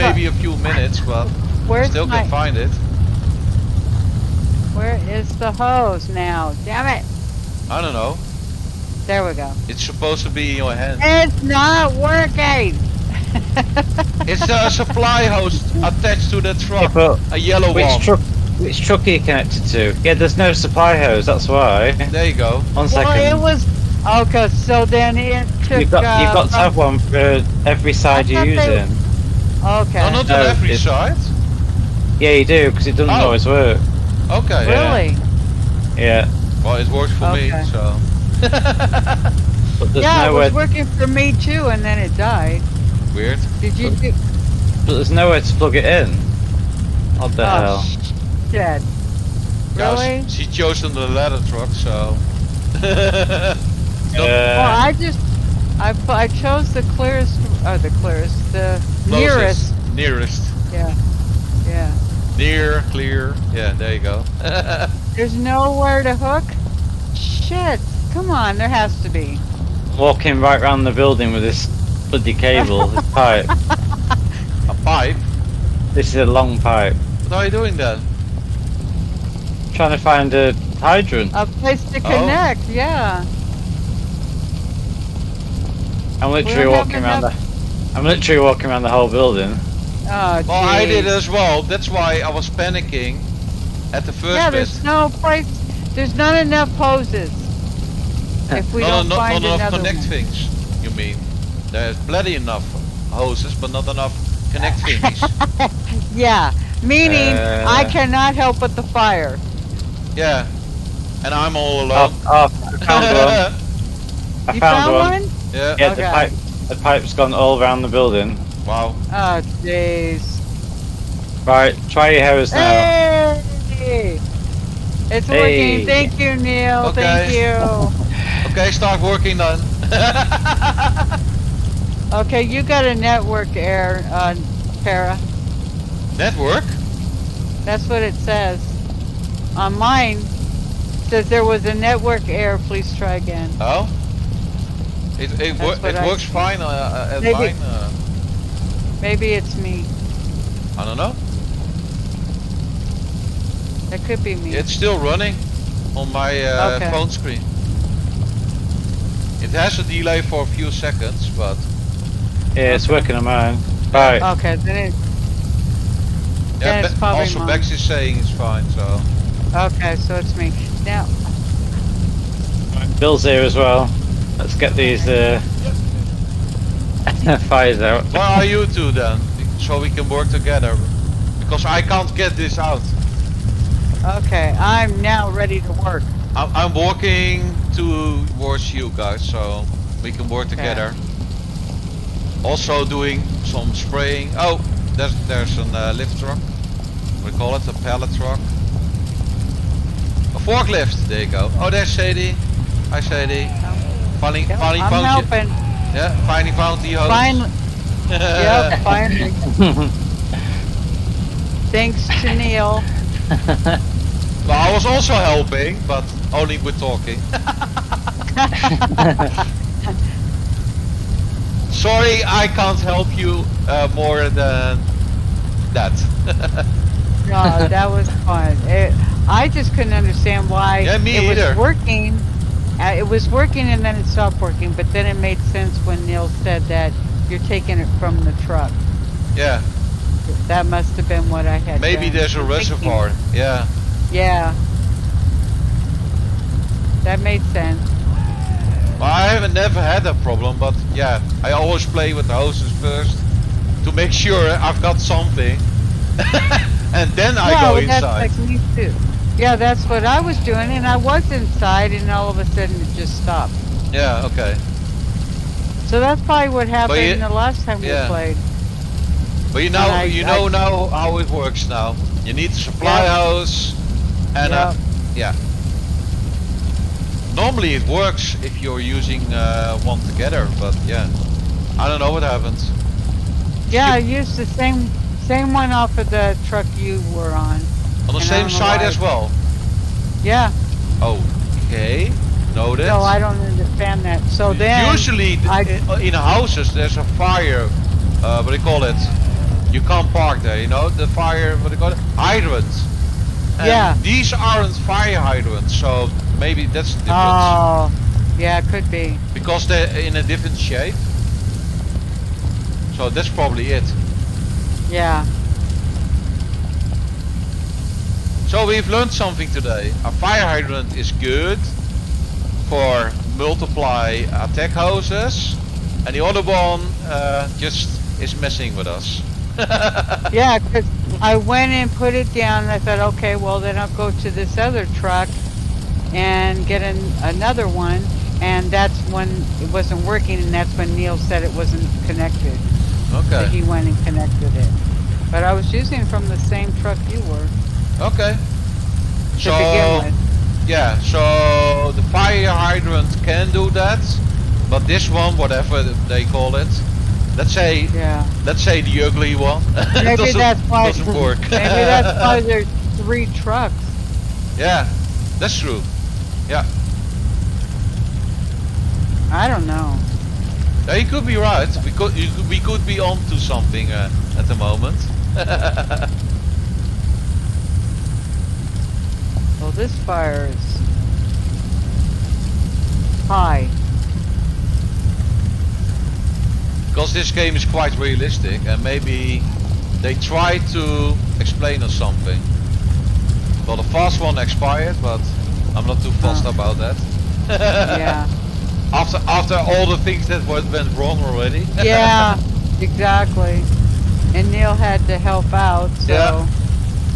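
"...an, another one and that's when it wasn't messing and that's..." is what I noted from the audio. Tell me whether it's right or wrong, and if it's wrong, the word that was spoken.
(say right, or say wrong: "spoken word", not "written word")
wrong: "working", not "messing".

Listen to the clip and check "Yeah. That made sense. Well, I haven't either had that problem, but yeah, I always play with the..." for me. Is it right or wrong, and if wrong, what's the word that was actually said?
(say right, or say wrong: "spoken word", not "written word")
wrong: "never", not "either".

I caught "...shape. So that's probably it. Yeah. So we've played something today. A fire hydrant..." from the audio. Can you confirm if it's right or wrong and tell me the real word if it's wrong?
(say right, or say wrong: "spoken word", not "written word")
wrong: "learned", not "played".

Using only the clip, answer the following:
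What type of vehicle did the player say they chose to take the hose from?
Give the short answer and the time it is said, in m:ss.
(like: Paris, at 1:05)
Ladder truck, at 0:51.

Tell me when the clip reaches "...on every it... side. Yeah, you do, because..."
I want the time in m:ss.
0:30.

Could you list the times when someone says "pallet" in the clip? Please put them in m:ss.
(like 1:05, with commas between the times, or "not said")
3:17.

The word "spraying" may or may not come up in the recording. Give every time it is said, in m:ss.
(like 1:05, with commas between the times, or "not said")
3:13.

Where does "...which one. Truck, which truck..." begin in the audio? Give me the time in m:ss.
0:17.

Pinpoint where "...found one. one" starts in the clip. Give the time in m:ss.
1:54.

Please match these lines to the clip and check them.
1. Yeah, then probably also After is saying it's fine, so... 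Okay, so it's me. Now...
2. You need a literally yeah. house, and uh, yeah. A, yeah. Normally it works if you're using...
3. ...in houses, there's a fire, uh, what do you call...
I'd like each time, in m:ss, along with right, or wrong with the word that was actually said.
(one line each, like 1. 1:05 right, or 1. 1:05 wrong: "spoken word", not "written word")
1. 2:46 wrong: "Bex", not "After"
2. 4:32 wrong: "supply", not "literally"
3. 4:55 right.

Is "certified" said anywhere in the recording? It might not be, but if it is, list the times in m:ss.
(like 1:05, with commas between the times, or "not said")
not said.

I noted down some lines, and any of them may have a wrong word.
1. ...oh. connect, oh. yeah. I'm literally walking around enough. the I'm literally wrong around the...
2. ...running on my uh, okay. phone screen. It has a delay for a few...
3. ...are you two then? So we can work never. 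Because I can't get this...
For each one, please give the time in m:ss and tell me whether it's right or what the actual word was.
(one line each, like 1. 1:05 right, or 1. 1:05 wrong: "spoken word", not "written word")
1. 1:21 wrong: "walking", not "wrong"
2. 2:34 right
3. 2:58 wrong: "together", not "never".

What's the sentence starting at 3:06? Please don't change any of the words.
I'm, walking towards you guys, so we can work okay.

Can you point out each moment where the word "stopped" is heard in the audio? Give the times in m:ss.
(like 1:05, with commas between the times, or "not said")
3:54, 4:23.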